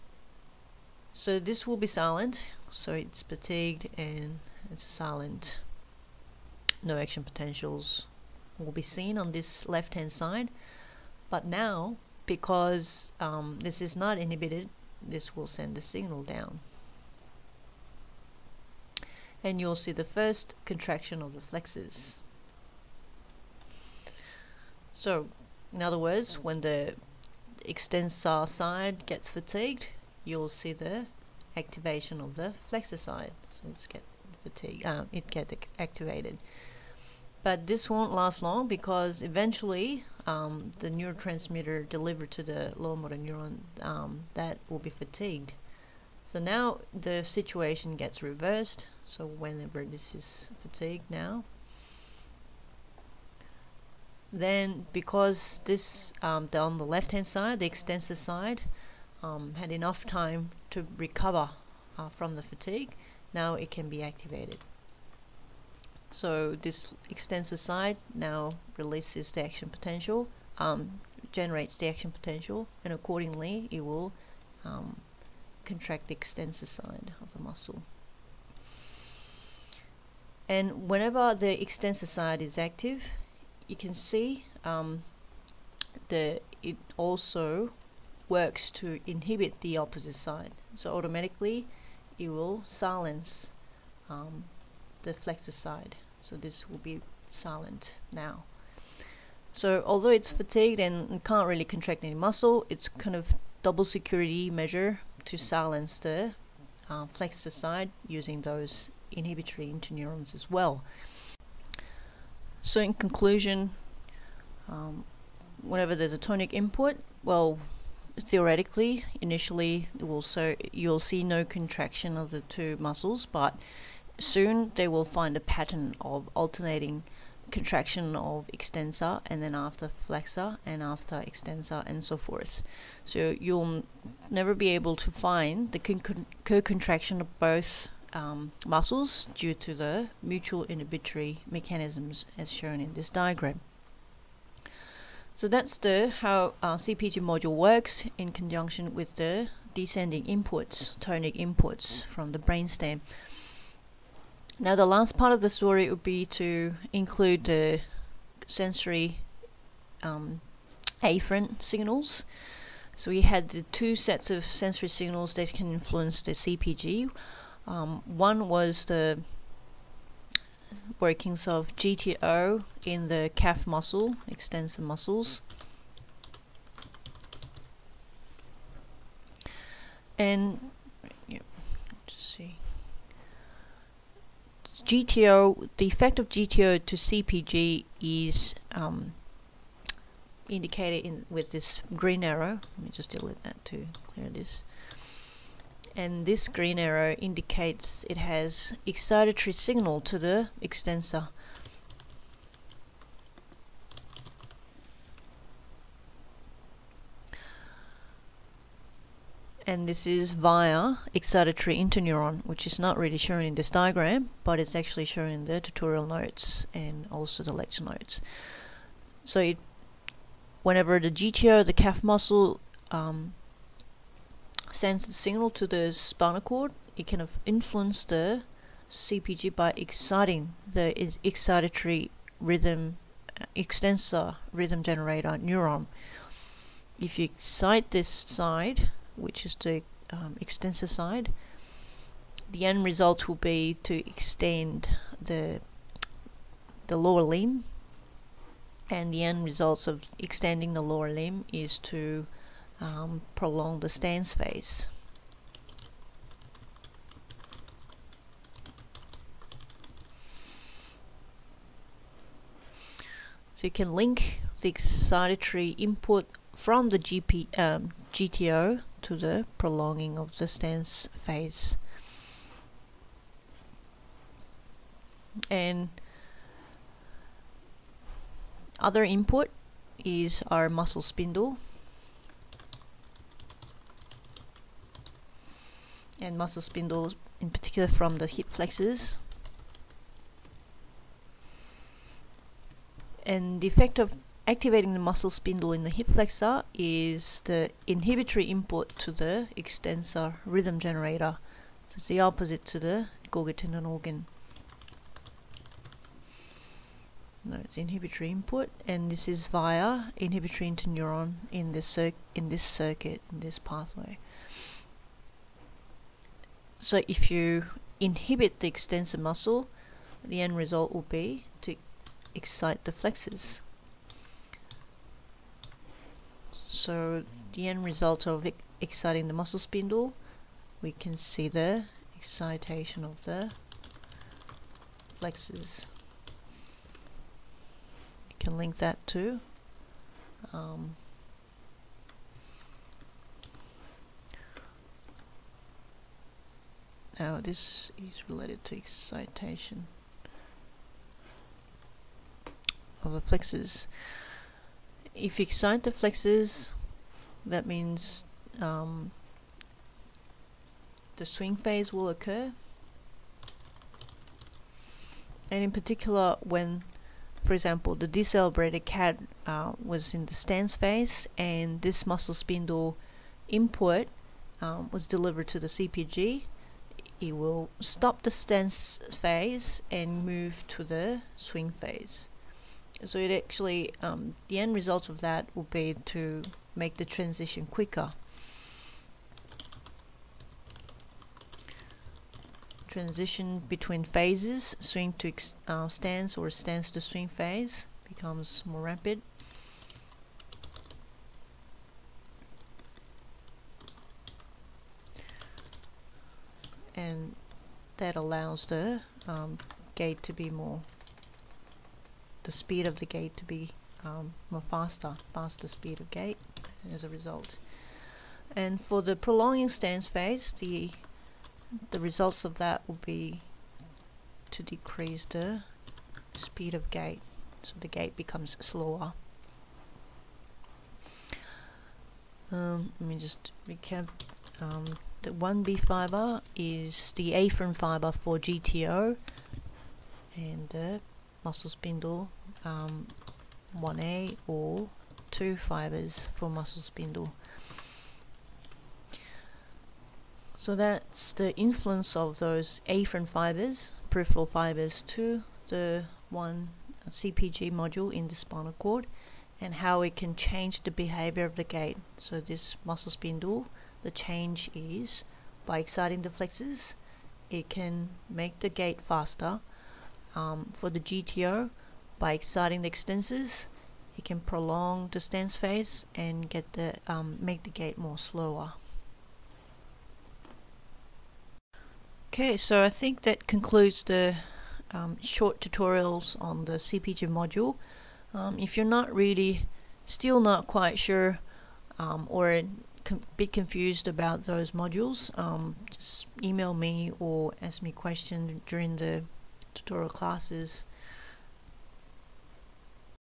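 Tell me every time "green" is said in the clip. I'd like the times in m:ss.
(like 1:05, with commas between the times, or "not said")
3:11, 3:16.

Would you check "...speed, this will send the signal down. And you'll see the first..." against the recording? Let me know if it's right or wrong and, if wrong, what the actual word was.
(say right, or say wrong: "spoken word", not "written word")
wrong: "inhibited", not "speed".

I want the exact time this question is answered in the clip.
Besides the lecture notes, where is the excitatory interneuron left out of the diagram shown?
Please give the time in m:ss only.
3:35.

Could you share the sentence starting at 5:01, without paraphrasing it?
So it's the opposite to the Golgi tendon organ.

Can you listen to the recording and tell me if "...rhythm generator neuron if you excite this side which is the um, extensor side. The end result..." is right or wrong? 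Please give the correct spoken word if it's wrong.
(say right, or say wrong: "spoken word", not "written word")
right.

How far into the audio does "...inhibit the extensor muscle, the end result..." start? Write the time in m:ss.
5:18.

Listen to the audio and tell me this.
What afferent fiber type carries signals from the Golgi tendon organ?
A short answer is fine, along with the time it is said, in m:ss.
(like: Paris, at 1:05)
1B fiber, at 7:15.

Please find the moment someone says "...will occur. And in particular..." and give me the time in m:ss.
6:01.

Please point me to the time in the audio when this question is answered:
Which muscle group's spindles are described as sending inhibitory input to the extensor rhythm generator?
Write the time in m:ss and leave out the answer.
4:48.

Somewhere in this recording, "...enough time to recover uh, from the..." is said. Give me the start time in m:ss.
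0:59.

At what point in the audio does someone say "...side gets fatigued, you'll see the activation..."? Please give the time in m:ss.
0:28.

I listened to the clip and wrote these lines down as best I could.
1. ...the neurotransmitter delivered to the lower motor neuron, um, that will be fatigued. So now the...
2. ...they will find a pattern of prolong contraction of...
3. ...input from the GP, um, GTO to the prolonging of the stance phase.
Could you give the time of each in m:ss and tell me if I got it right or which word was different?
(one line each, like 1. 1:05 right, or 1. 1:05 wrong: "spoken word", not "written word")
1. 0:40 right
2. 2:04 wrong: "alternating", not "prolong"
3. 4:25 right.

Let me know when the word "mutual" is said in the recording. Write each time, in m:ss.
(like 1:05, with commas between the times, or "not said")
2:20.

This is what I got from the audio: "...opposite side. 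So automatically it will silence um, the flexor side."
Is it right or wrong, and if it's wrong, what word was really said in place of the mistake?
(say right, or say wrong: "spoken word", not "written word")
right.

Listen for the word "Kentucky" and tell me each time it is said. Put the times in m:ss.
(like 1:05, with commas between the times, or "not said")
not said.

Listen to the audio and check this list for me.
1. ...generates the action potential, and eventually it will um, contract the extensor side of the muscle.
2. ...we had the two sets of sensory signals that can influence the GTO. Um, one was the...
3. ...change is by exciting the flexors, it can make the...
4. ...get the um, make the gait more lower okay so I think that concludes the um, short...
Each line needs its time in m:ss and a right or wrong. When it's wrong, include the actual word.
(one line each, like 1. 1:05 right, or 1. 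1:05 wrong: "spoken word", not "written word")
1. 1:11 wrong: "accordingly", not "eventually"
2. 2:43 wrong: "CPG", not "GTO"
3. 7:44 right
4. 7:56 wrong: "slower", not "lower".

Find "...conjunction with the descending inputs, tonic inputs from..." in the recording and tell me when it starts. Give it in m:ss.
2:28.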